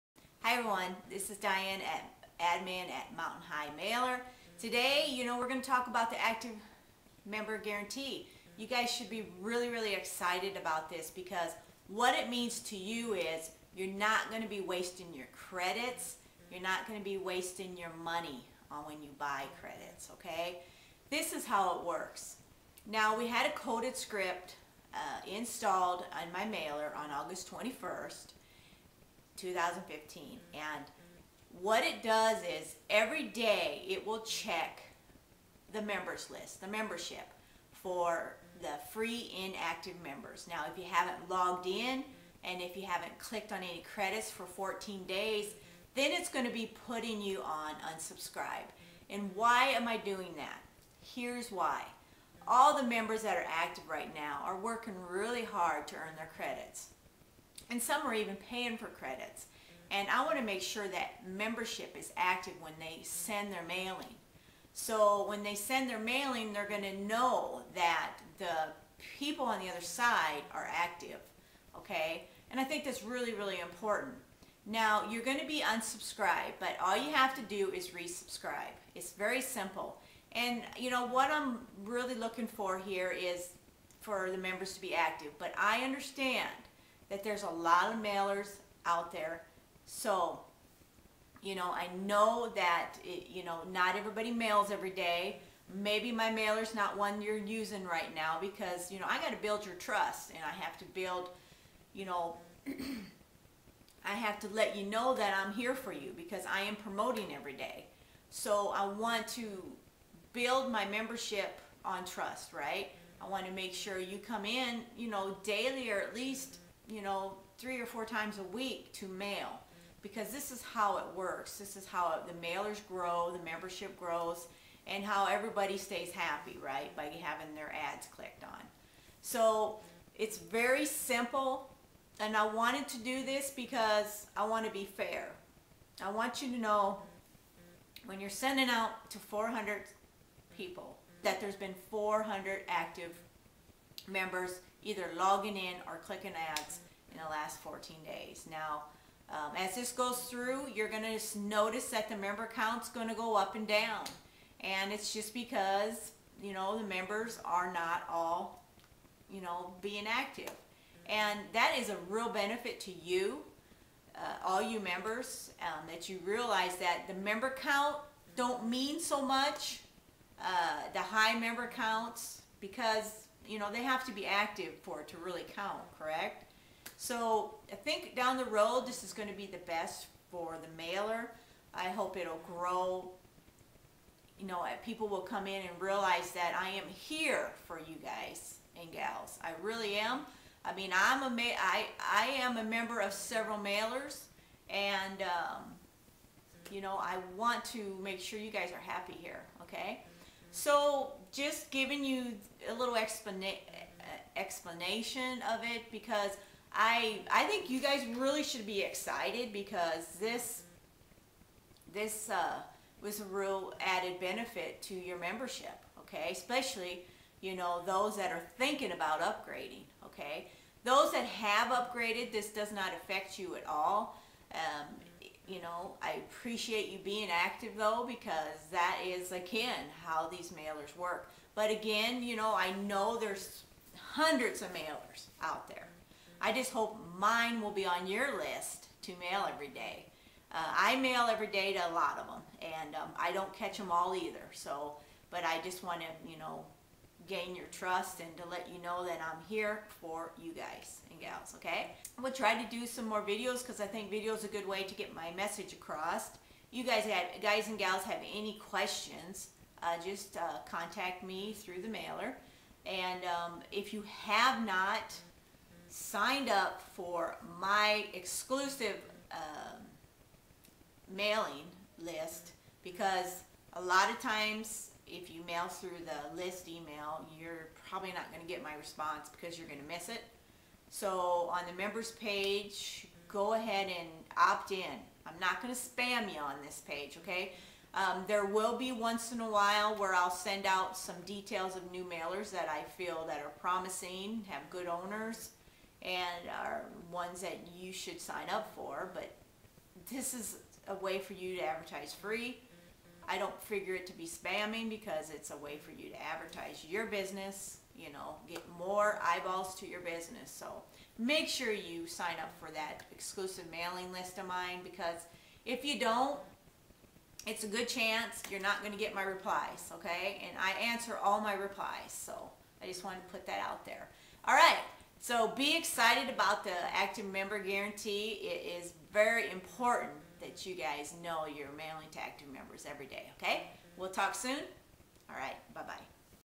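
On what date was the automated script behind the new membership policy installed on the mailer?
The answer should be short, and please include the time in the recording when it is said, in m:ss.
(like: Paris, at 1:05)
August 21, 2015, at 0:27.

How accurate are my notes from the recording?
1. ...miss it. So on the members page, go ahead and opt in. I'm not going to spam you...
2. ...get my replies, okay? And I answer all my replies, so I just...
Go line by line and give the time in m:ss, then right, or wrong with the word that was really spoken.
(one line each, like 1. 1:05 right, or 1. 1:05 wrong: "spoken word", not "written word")
1. 4:39 right
2. 5:18 right.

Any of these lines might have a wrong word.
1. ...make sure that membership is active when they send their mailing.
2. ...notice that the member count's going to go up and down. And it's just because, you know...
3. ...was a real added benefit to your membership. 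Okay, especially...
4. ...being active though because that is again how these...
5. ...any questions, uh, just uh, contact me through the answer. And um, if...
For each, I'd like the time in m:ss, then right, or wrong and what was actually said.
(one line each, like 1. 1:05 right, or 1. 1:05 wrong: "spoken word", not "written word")
1. 1:00 right
2. 2:31 right
3. 3:33 right
4. 3:46 right
5. 4:18 wrong: "mailer", not "answer".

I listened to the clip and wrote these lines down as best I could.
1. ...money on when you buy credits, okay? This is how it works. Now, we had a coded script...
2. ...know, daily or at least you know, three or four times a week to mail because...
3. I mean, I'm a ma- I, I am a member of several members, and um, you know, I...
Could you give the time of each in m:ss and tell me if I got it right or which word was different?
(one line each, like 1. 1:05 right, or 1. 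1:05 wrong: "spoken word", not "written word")
1. 0:18 right
2. 1:55 right
3. 3:10 wrong: "mailers", not "members".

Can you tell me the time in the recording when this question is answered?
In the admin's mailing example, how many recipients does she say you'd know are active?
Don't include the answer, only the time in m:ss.
2:19.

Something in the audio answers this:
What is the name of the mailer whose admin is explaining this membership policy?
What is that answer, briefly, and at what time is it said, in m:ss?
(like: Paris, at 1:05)
Mountain High Mailer, at 0:03.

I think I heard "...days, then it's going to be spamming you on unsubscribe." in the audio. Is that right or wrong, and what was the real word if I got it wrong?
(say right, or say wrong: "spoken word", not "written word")
wrong: "putting", not "spamming".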